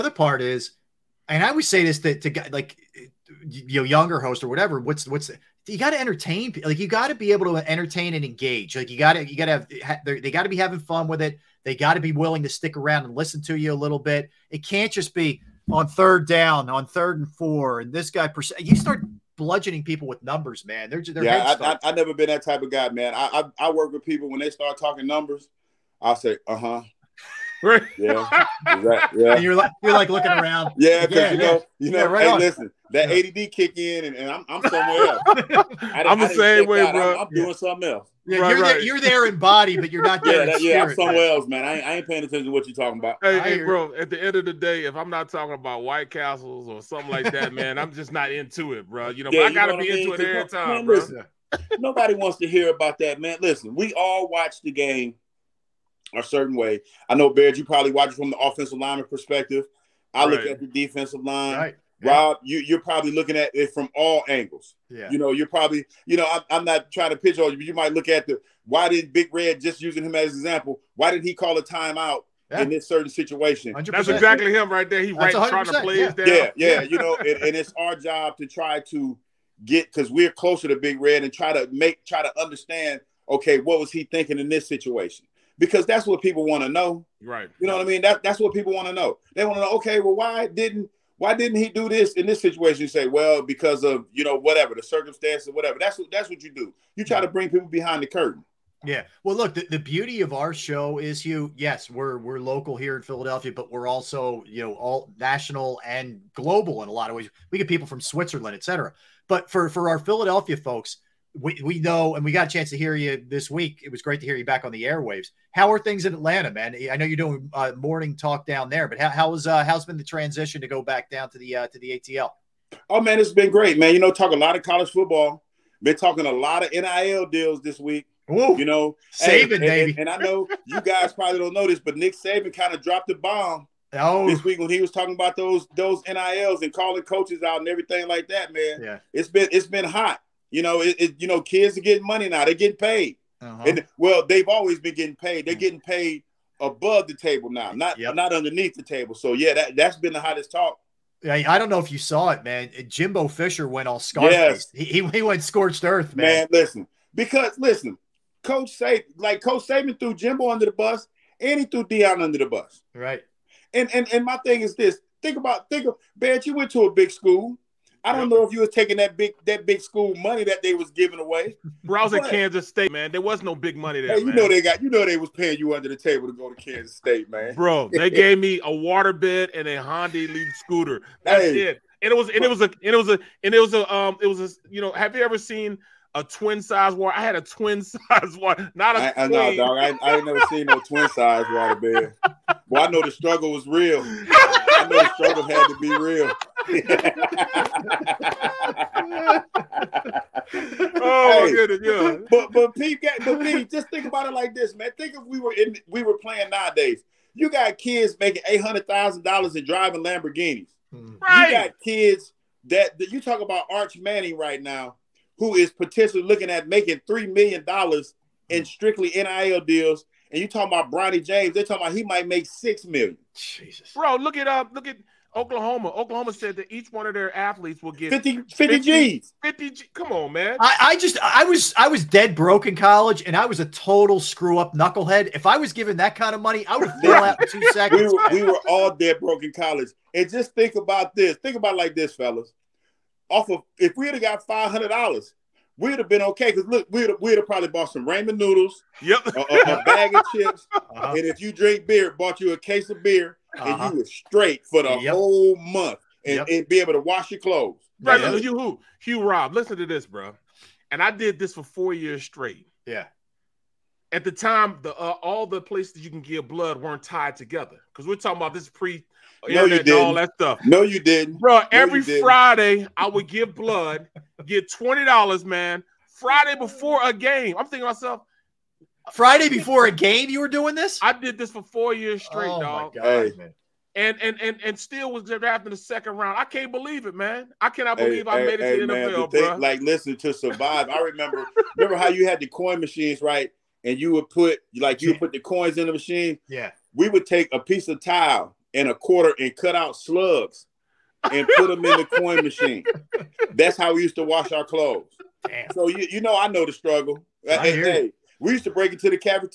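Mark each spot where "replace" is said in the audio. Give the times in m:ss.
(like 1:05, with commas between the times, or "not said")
not said.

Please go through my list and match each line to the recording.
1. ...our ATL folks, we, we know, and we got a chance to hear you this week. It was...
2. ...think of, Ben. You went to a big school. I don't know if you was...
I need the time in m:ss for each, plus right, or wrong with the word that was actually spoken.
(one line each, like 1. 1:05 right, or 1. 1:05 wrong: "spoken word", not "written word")
1. 1:49 wrong: "Philadelphia", not "ATL"
2. 2:45 right.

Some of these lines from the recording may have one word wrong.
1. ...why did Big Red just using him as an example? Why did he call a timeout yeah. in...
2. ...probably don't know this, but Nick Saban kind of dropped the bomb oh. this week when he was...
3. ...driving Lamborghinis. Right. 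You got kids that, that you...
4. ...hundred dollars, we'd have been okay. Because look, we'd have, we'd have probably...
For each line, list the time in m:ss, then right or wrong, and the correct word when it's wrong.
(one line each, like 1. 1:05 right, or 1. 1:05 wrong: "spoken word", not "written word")
1. 1:08 right
2. 2:11 right
3. 3:29 right
4. 4:04 right.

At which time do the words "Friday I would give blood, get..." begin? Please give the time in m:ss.
4:32.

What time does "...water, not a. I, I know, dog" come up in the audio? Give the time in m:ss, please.
3:08.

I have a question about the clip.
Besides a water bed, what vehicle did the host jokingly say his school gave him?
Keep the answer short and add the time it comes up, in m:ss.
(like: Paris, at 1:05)
Honda Elite scooter, at 2:59.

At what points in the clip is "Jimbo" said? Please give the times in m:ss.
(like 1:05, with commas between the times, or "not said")
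2:32, 2:40.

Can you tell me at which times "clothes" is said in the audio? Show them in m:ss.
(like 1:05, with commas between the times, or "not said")
4:17, 5:04.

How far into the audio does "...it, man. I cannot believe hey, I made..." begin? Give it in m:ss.
4:47.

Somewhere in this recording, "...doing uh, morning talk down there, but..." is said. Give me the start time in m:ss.
1:57.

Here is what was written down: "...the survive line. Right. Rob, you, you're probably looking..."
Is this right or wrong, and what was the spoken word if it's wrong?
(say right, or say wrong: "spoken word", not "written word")
wrong: "defensive", not "survive".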